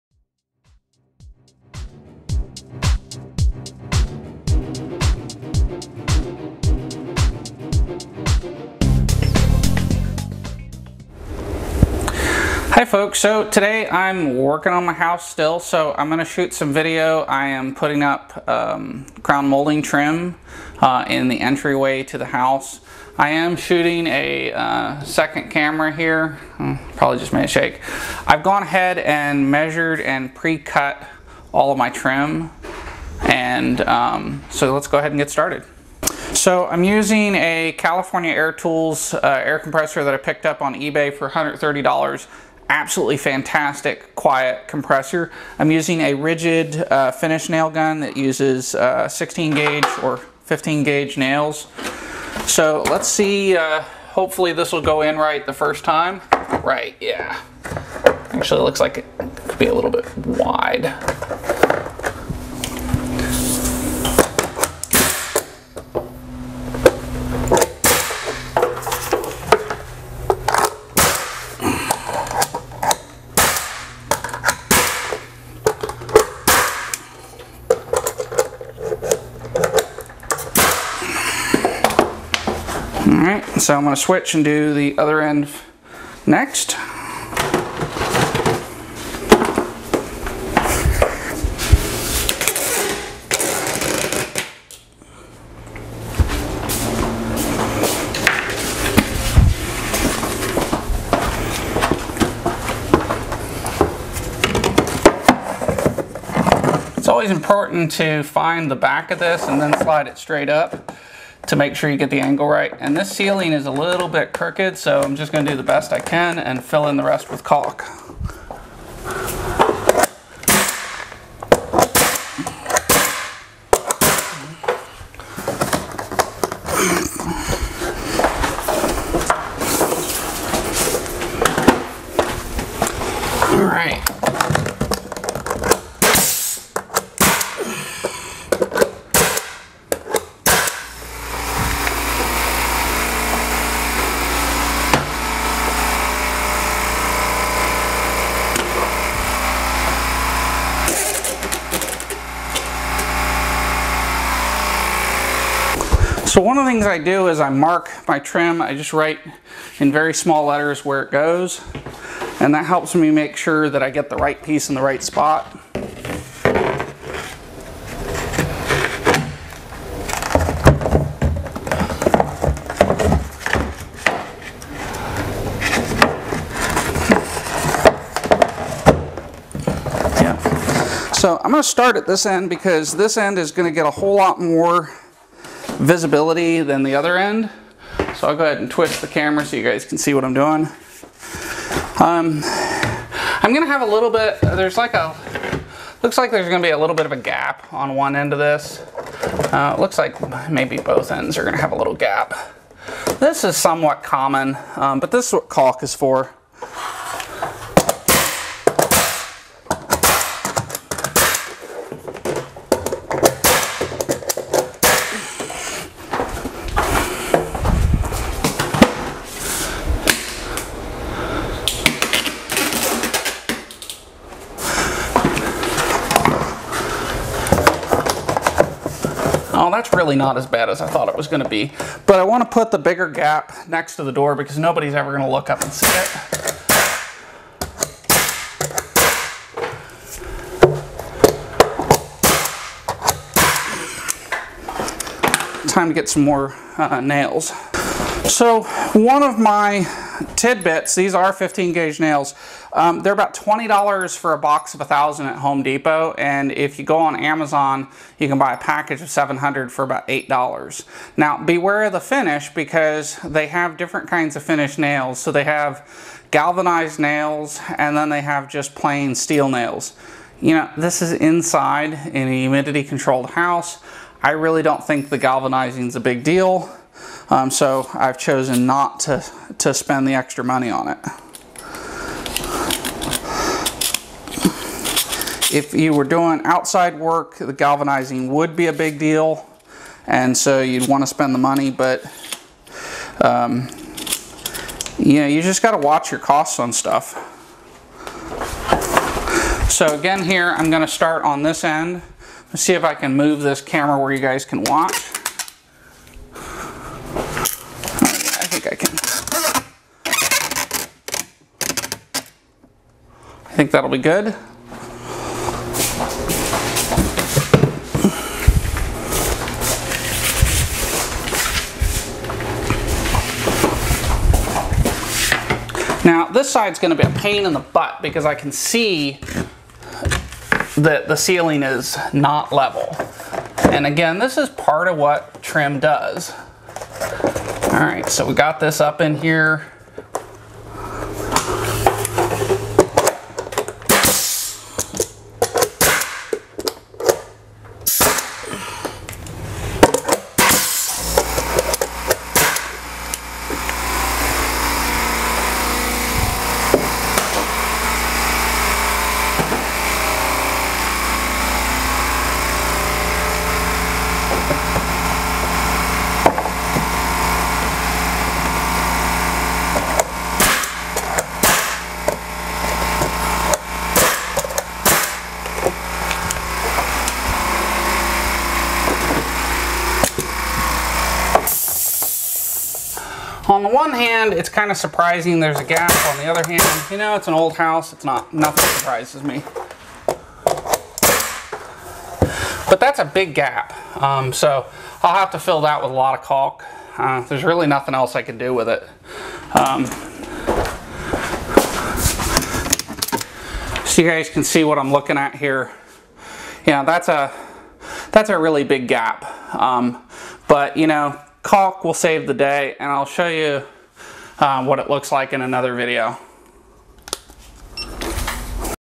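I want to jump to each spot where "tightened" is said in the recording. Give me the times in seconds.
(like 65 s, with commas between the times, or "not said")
not said.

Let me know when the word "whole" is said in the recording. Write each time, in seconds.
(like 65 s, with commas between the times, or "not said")
183 s.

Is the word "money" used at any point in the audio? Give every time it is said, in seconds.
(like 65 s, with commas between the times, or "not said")
280 s, 291 s.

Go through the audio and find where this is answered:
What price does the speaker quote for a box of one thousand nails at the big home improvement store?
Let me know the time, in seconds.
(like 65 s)
253 s.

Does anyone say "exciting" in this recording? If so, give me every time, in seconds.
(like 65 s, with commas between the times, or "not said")
not said.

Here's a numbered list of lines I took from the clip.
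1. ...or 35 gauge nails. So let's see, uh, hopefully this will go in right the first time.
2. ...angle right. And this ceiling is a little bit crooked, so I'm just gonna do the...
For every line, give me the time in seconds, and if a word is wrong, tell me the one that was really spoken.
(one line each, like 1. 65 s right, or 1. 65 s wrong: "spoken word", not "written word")
1. 50 s wrong: "15", not "35"
2. 112 s right.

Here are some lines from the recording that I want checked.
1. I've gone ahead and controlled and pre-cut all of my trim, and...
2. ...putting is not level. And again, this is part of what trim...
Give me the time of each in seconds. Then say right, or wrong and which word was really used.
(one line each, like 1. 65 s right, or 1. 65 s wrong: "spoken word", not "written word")
1. 28 s wrong: "measured", not "controlled"
2. 331 s wrong: "ceiling", not "putting".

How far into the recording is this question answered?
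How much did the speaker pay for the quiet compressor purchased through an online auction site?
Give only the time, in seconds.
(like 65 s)
41 s.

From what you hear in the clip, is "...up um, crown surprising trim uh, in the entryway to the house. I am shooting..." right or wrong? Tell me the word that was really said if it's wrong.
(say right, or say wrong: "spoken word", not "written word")
wrong: "molding", not "surprising".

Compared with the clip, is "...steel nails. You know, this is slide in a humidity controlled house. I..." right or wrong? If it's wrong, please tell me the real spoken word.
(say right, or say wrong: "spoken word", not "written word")
wrong: "inside", not "slide".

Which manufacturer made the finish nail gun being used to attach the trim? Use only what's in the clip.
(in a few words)
Ridgid.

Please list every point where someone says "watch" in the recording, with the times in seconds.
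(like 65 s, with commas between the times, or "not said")
295 s, 304 s.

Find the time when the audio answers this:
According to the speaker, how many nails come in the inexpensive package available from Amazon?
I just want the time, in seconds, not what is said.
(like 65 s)
259 s.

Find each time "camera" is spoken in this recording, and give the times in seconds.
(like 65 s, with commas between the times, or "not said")
25 s, 189 s, 303 s.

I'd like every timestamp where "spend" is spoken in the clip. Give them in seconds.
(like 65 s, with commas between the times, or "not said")
279 s, 291 s.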